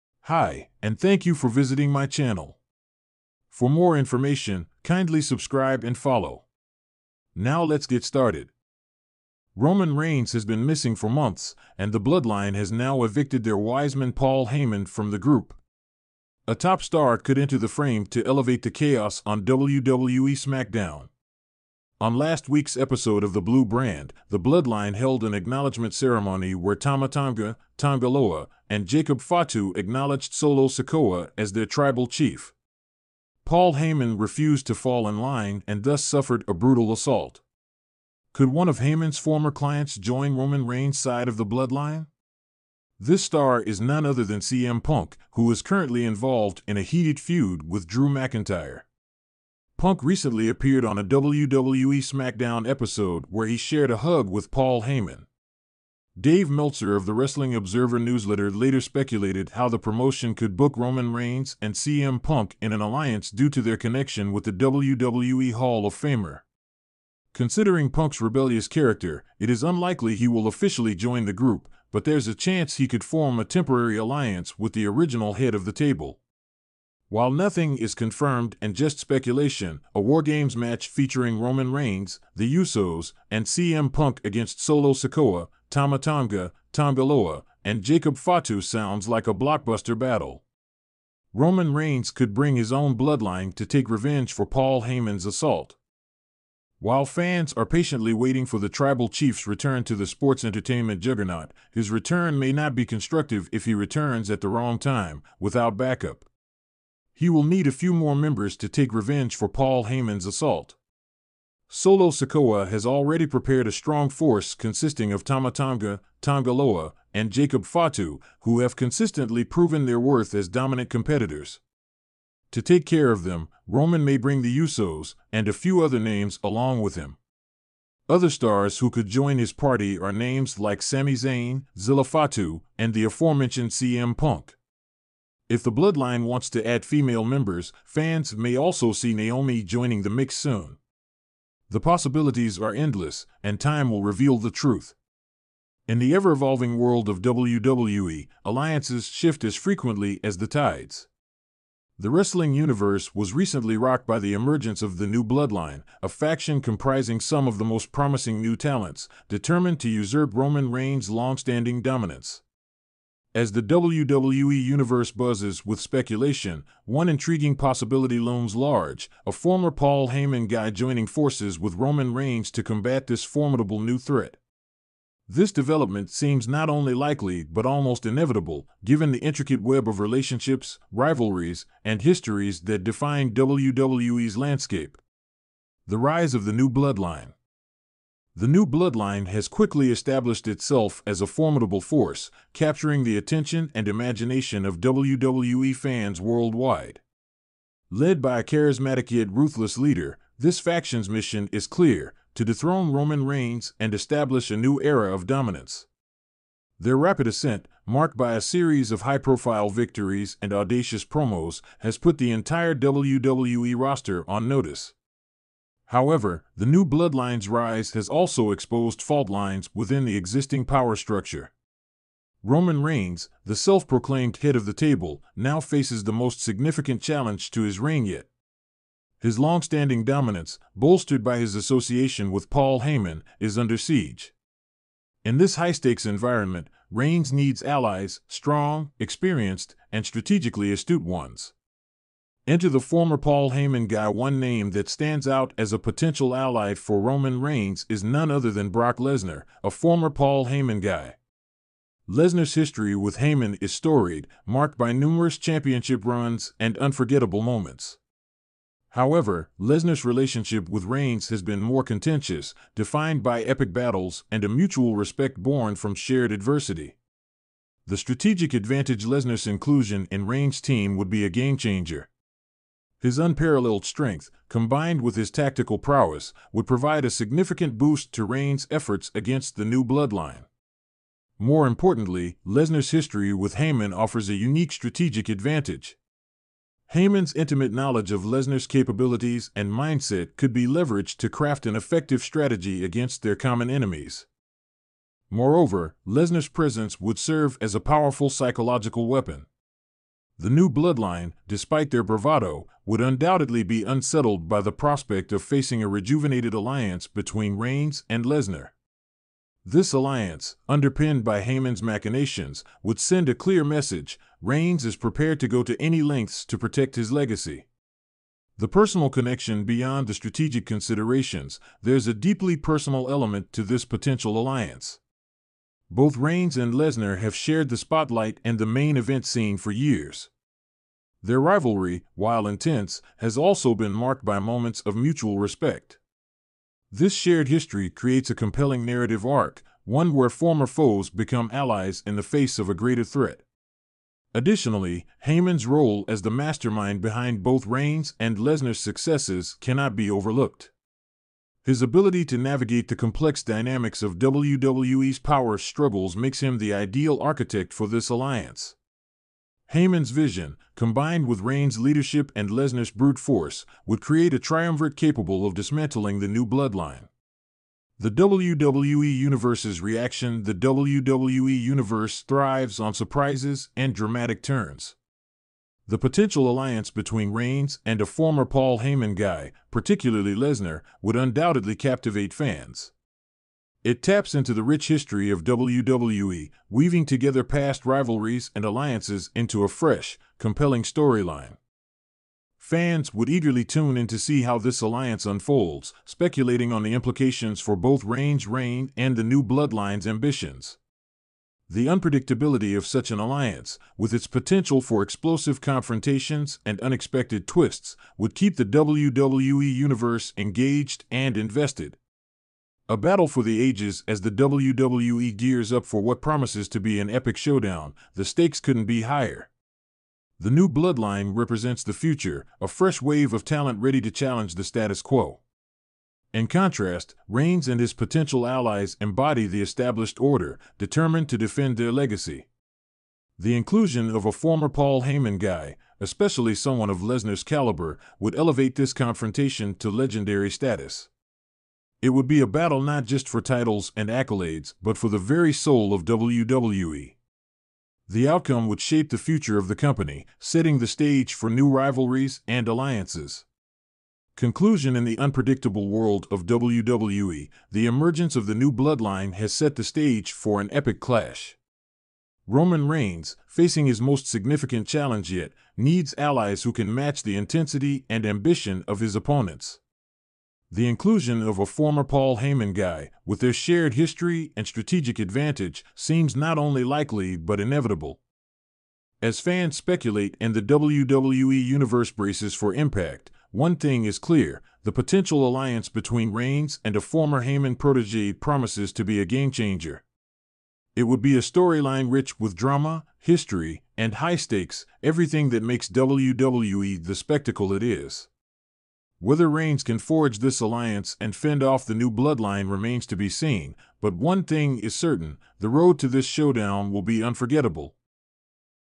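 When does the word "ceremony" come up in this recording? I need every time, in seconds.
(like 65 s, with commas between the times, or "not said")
25 s.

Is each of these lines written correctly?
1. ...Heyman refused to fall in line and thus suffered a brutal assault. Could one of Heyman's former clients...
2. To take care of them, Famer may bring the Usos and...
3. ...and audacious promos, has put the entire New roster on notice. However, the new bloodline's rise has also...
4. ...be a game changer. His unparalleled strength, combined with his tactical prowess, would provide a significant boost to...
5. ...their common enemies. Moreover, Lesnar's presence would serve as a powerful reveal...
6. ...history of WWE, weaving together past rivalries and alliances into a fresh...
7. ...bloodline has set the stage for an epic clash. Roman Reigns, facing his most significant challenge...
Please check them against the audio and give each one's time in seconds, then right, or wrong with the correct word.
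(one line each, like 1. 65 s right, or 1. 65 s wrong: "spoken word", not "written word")
1. 33 s right
2. 122 s wrong: "Roman", not "Famer"
3. 210 s wrong: "WWE", not "New"
4. 271 s right
5. 293 s wrong: "psychological", not "reveal"
6. 384 s right
7. 458 s right.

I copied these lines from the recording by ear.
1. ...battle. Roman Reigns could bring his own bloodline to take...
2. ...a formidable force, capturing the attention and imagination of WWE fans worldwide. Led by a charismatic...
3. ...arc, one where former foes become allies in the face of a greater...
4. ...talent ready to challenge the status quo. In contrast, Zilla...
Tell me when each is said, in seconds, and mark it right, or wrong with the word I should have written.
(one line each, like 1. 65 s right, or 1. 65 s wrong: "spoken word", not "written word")
1. 89 s right
2. 191 s right
3. 339 s right
4. 423 s wrong: "Reigns", not "Zilla".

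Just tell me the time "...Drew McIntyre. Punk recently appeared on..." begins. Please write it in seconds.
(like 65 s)
47 s.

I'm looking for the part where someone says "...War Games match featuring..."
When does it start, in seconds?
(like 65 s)
79 s.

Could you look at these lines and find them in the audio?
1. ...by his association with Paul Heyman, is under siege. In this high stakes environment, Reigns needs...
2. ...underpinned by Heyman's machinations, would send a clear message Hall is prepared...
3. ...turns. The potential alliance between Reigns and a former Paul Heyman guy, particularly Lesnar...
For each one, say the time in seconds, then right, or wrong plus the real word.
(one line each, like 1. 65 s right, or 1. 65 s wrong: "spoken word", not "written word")
1. 231 s right
2. 310 s wrong: "Reigns", not "Hall"
3. 374 s right.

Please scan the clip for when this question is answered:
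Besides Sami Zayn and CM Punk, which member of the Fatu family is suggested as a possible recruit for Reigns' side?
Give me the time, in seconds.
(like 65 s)
131 s.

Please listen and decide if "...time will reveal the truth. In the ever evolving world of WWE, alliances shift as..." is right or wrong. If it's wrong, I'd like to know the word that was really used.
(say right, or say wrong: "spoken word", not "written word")
right.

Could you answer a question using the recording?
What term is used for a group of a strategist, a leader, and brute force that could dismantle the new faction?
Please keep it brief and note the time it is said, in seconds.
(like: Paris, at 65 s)
Triumvirate, at 364 s.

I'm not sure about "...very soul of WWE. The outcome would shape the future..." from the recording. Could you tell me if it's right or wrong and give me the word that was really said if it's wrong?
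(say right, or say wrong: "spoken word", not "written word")
right.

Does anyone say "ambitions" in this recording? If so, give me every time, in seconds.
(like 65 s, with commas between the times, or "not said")
400 s, 468 s.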